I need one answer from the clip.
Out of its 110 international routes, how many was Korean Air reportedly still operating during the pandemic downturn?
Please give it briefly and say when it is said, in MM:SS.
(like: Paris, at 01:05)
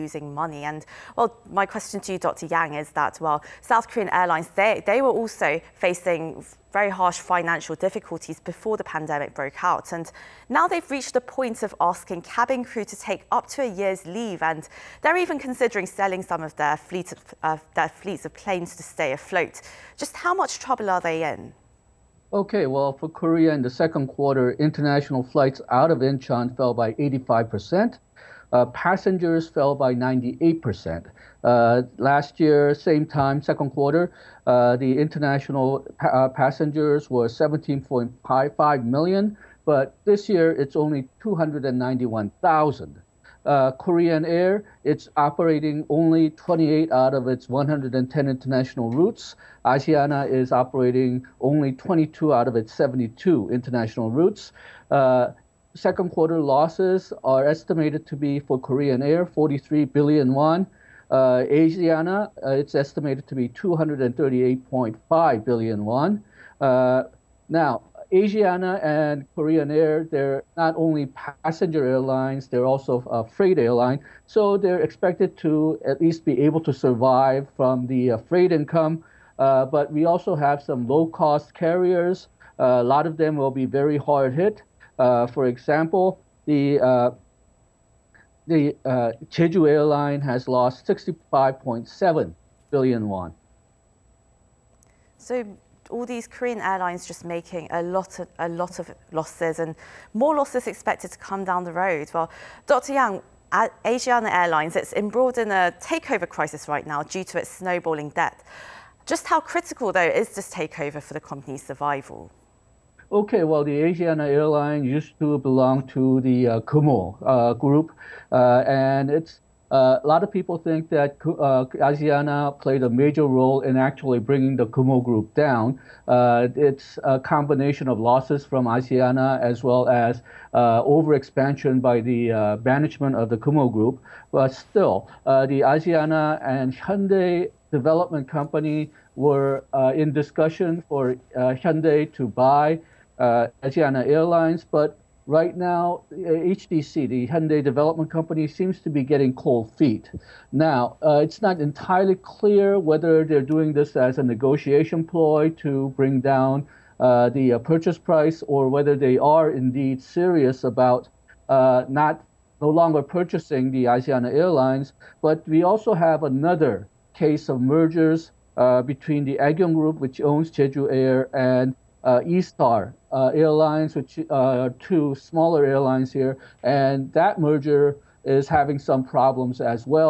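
28, at 00:46.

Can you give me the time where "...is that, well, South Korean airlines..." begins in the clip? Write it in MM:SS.
00:02.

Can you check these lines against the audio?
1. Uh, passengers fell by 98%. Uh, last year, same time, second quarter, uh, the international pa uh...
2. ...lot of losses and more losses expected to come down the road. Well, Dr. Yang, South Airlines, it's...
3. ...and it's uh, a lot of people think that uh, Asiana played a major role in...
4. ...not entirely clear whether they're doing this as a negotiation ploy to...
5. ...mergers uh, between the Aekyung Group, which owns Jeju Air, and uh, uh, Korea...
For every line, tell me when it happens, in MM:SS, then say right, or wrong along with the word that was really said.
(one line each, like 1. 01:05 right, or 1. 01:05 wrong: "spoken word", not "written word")
1. 00:28 right
2. 01:38 wrong: "Asiana", not "South"
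3. 01:58 right
4. 02:31 right
5. 02:47 wrong: "Airlines", not "Korea".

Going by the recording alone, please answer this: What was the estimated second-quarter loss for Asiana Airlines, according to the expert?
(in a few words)
238.5 billion won.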